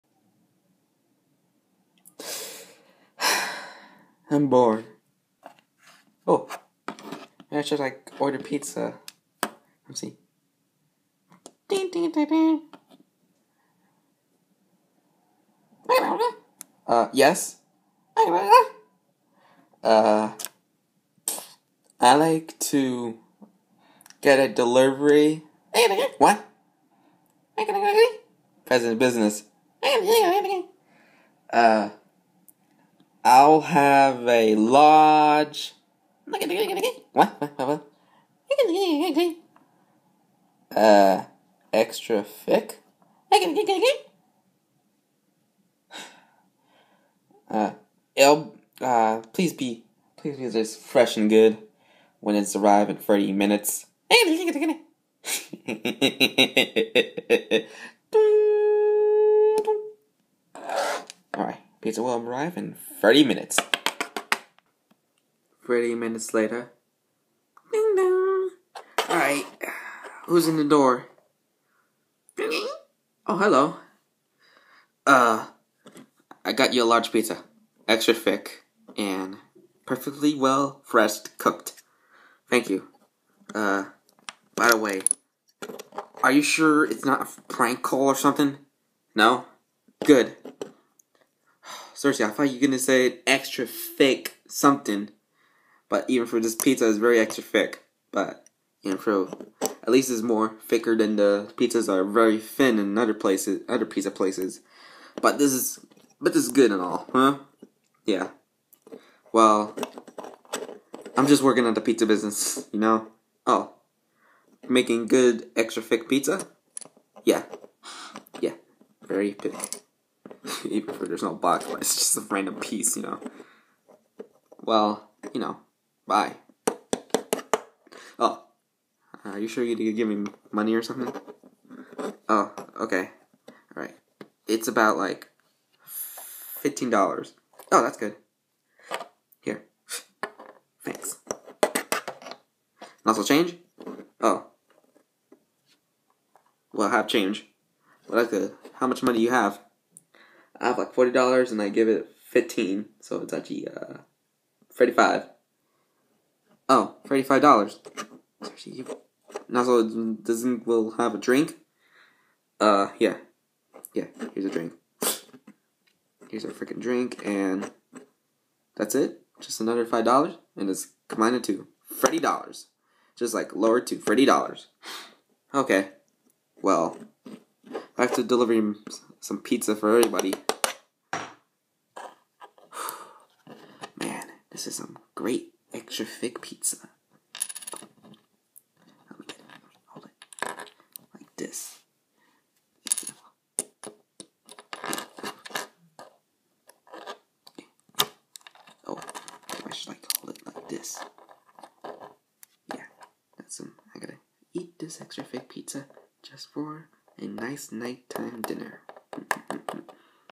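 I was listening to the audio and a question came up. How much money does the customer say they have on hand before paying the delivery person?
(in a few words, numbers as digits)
$40.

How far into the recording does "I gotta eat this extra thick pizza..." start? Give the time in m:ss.
3:23.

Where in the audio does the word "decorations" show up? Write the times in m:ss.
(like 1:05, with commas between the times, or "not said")
not said.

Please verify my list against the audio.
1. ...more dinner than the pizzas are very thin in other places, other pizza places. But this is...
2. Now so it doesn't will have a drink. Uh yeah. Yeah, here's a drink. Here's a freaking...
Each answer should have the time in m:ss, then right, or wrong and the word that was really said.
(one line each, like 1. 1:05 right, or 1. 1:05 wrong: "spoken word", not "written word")
1. 1:40 wrong: "thicker", not "dinner"
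2. 2:39 right.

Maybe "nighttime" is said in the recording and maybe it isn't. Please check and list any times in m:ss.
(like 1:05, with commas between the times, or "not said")
3:27.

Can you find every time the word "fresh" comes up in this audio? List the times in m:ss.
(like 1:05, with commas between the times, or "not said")
0:50, 1:20.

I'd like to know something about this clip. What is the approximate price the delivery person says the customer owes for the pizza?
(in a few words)
$15.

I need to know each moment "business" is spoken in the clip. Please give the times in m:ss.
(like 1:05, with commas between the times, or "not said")
0:28, 1:52.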